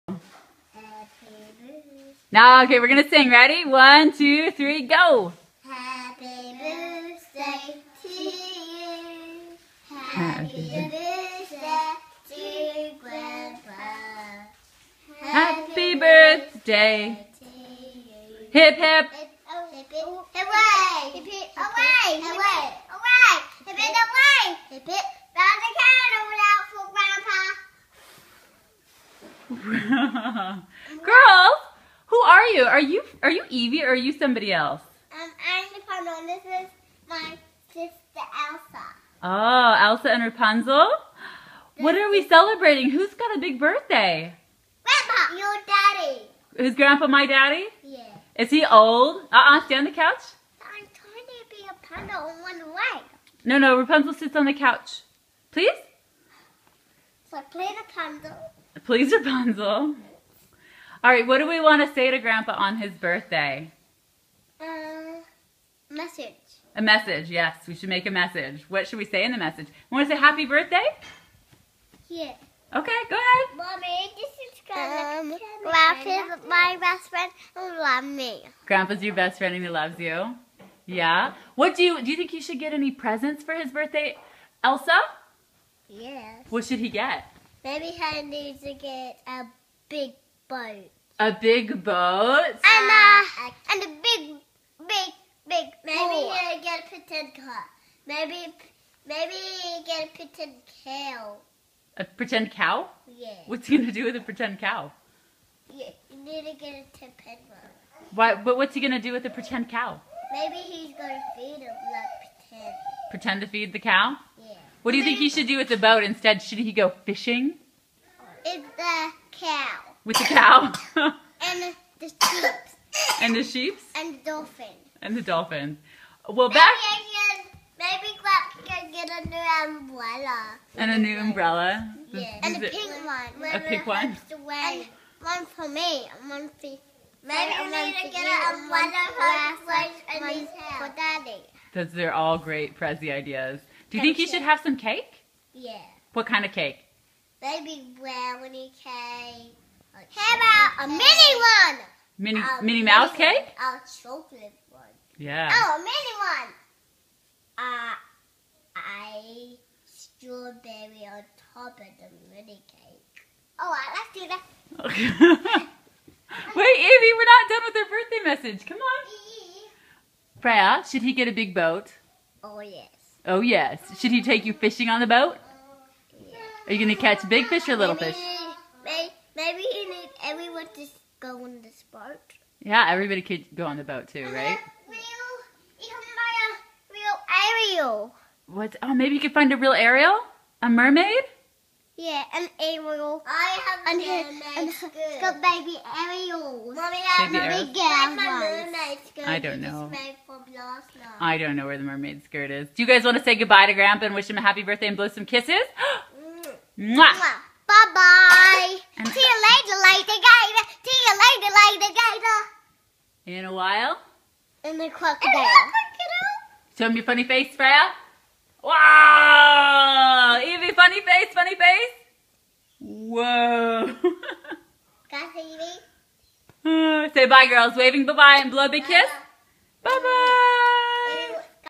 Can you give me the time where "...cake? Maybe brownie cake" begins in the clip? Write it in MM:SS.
02:26.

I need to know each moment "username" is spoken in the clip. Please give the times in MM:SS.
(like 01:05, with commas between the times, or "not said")
not said.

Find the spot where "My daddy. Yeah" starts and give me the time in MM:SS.
00:47.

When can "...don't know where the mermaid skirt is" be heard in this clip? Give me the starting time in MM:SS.
03:21.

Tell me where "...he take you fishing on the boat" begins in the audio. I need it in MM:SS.
02:54.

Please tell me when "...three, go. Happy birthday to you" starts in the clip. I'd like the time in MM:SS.
00:04.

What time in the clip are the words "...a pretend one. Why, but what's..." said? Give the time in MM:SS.
01:46.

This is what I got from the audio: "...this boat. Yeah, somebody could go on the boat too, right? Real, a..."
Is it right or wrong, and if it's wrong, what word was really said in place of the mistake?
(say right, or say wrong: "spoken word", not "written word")
wrong: "everybody", not "somebody".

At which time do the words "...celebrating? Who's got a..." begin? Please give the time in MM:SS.
00:42.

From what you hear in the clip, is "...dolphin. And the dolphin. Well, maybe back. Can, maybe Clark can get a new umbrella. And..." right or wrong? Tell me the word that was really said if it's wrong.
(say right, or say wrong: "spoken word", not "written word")
right.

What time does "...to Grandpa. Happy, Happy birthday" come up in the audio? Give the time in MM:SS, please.
00:12.